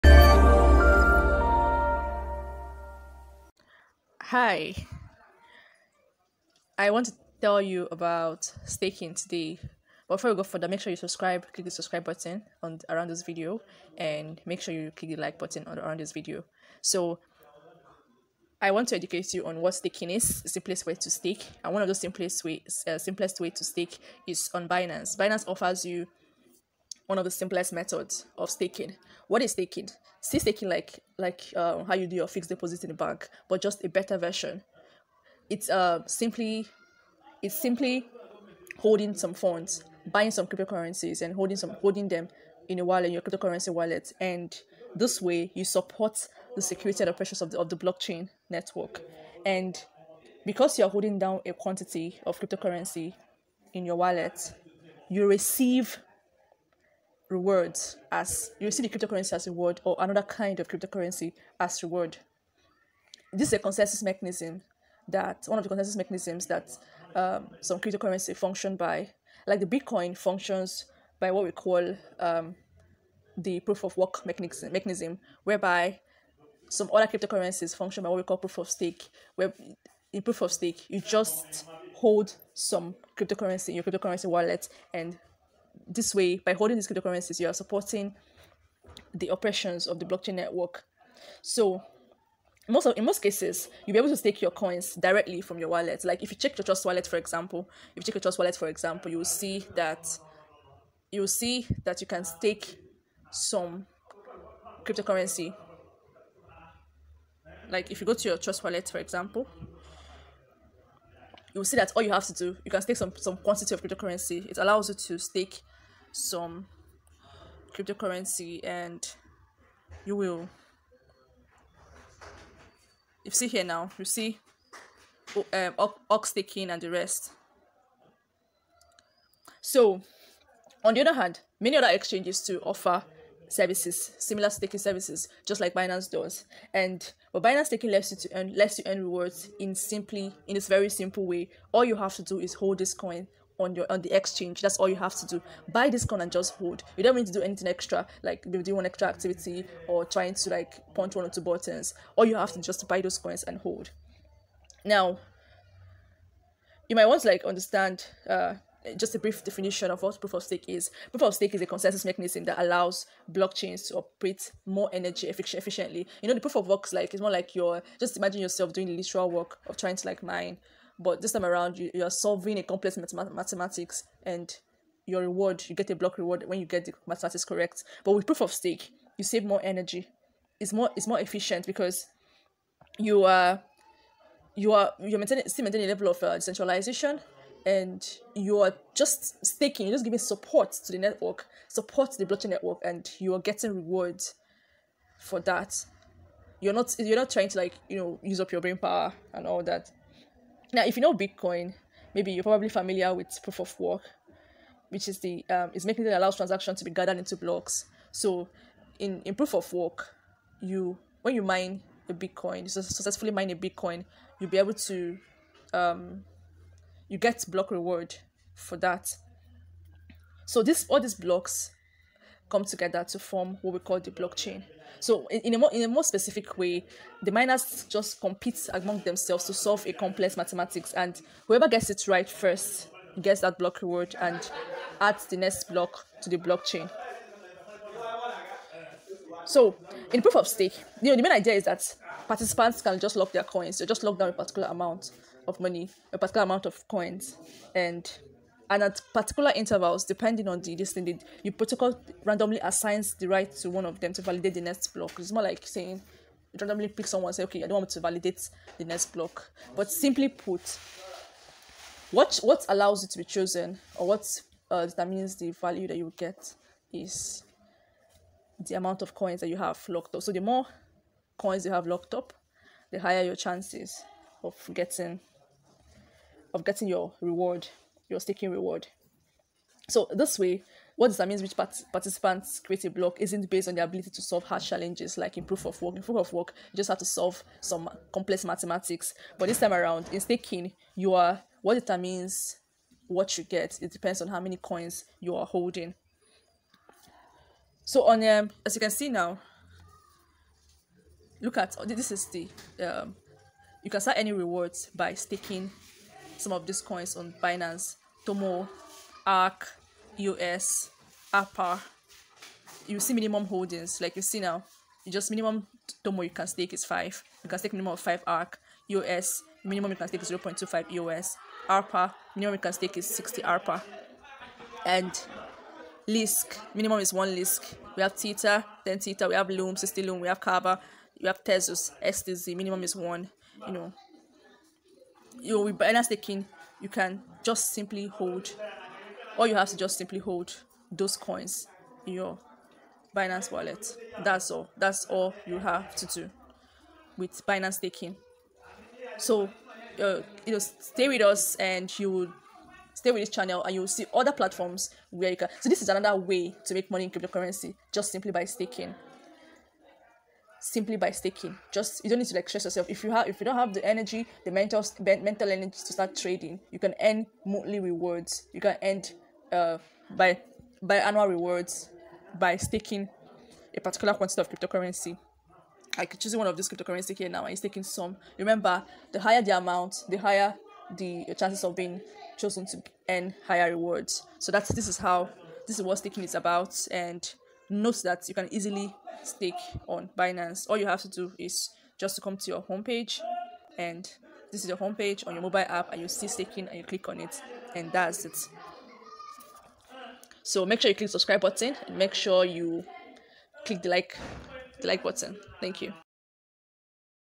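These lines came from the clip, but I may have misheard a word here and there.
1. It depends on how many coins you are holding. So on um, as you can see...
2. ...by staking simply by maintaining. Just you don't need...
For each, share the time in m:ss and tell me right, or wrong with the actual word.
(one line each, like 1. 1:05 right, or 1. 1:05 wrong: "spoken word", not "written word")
1. 4:53 right
2. 5:58 wrong: "staking", not "maintaining".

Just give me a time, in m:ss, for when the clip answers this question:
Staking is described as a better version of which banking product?
0:32.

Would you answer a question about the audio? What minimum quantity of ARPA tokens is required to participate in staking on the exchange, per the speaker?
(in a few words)
60.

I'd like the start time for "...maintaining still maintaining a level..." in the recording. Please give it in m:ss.
3:05.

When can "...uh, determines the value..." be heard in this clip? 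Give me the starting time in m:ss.
4:24.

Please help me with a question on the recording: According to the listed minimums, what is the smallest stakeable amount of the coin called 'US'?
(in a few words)
0.25.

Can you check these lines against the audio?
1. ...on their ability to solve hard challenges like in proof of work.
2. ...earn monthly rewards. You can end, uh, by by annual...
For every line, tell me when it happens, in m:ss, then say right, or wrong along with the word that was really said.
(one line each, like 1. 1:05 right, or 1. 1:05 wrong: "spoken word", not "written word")
1. 4:43 right
2. 6:07 right.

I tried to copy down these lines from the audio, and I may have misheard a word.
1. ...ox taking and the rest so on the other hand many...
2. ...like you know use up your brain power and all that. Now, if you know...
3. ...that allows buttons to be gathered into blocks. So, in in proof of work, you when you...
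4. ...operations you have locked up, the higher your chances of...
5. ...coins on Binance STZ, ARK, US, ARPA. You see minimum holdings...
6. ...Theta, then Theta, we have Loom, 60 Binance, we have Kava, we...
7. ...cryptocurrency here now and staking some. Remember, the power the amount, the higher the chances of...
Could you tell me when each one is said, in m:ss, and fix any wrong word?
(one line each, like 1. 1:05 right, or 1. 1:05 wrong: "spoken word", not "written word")
1. 2:06 right
2. 3:17 right
3. 3:26 wrong: "transactions", not "buttons"
4. 4:31 wrong: "coins", not "operations"
5. 5:06 wrong: "Tomo", not "STZ"
6. 5:28 wrong: "Loom", not "Binance"
7. 6:16 wrong: "higher", not "power".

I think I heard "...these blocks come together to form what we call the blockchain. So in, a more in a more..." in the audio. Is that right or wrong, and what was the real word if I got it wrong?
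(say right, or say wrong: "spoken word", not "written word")
right.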